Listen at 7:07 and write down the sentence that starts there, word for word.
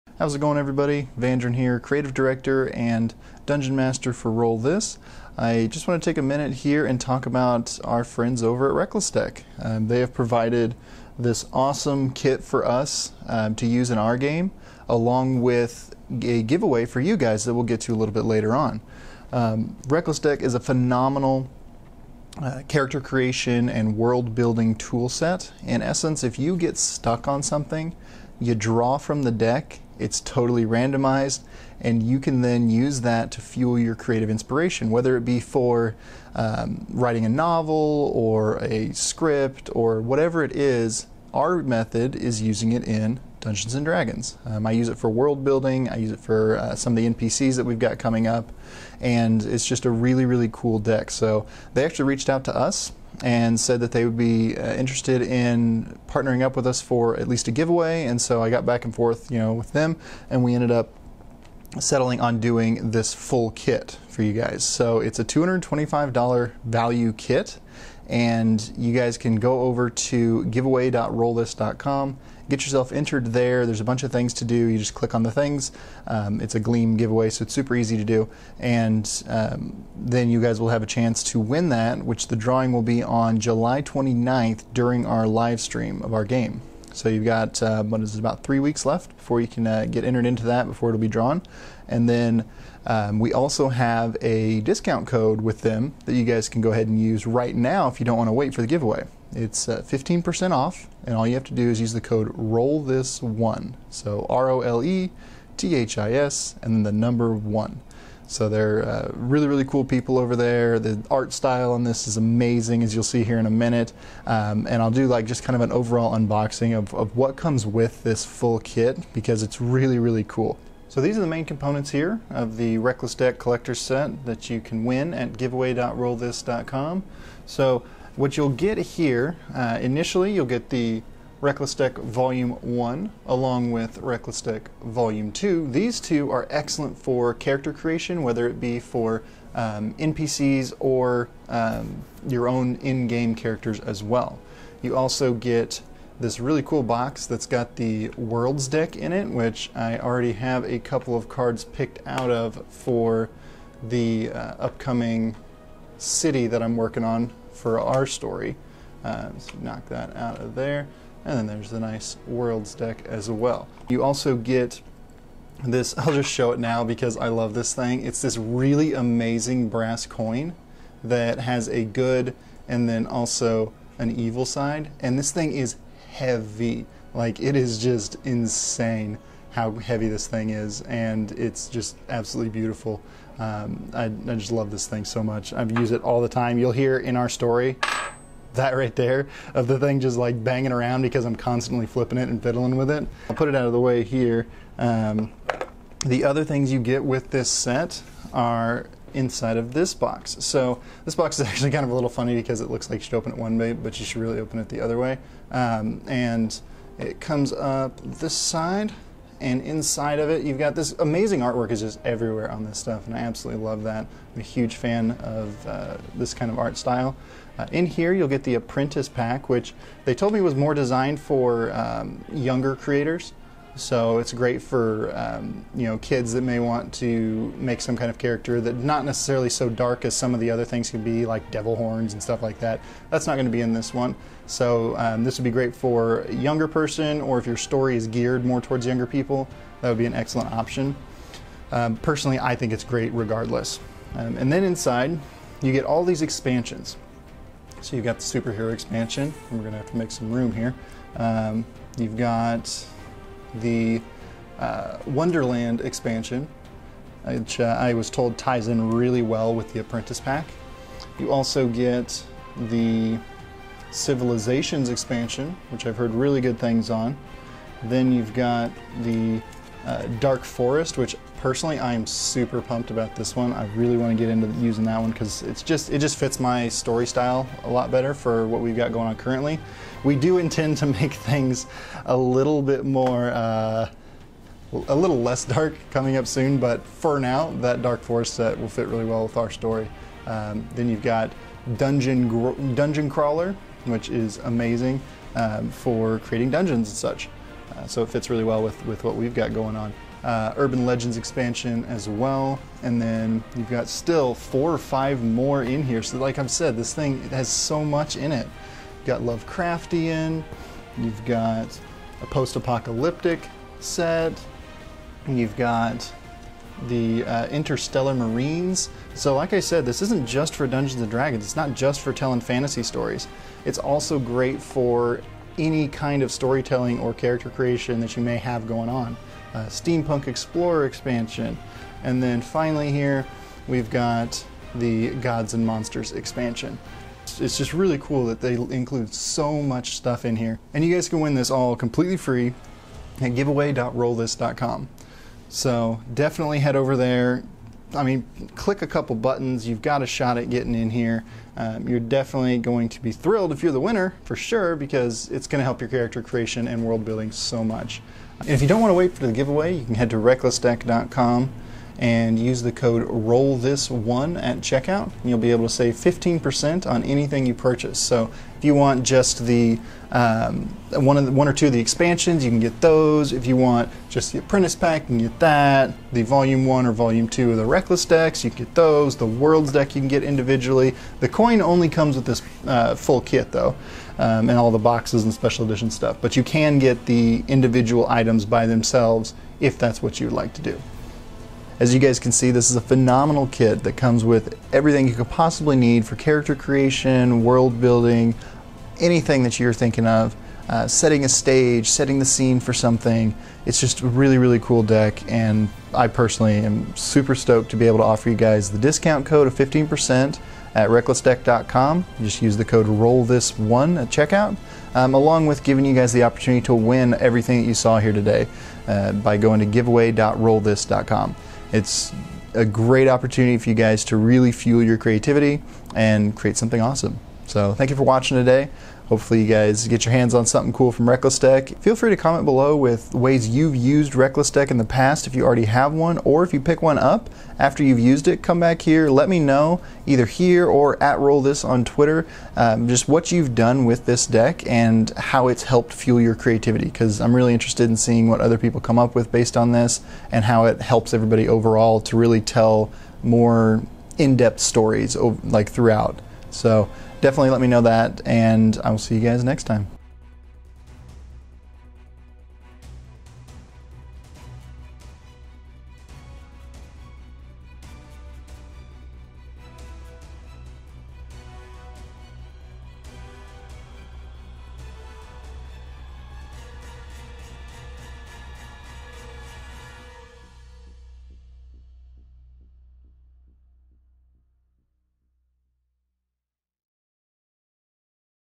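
So thank you for watching today.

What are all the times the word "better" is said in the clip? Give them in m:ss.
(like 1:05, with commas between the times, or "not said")
4:37.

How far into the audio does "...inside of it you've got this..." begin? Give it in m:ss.
3:29.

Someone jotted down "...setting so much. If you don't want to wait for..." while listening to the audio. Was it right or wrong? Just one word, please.
wrong.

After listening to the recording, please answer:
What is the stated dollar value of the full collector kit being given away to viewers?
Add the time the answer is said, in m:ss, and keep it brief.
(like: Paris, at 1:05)
$225, at 1:05.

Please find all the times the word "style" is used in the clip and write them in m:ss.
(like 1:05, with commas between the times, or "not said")
1:51, 3:36, 4:37.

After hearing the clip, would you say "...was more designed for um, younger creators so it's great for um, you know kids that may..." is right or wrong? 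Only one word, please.
right.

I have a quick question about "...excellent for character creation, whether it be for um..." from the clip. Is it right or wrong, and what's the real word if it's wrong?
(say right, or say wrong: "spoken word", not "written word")
right.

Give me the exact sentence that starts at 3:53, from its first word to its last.
That's not going to be in this one.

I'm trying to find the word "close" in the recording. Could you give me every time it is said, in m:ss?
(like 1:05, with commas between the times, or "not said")
not said.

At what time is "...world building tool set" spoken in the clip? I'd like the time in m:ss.
0:23.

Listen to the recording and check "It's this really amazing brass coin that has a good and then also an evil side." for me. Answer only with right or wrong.
right.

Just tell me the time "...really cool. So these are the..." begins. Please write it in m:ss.
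1:59.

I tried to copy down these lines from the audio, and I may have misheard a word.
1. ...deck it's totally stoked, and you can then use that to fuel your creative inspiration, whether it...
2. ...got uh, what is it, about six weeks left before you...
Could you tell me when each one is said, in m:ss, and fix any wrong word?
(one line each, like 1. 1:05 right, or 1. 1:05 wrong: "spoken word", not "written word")
1. 0:29 wrong: "randomized", not "stoked"
2. 1:27 wrong: "three", not "six".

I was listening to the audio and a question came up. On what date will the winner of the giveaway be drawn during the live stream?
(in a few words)
July 29th.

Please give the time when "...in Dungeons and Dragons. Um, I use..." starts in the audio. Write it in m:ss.
0:42.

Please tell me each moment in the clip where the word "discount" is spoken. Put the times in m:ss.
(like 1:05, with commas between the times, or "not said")
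1:34, 6:48.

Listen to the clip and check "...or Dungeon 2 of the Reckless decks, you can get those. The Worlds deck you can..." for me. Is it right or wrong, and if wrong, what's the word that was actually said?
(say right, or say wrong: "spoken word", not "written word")
wrong: "Volume", not "Dungeon".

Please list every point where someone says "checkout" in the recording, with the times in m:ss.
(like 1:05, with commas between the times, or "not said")
6:04, 6:54.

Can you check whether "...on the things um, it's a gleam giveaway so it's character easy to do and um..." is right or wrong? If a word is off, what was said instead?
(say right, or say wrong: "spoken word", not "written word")
wrong: "super", not "character".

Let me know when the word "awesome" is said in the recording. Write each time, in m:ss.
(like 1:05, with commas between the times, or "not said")
0:11, 7:06.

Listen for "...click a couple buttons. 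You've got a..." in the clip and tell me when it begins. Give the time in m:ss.
5:48.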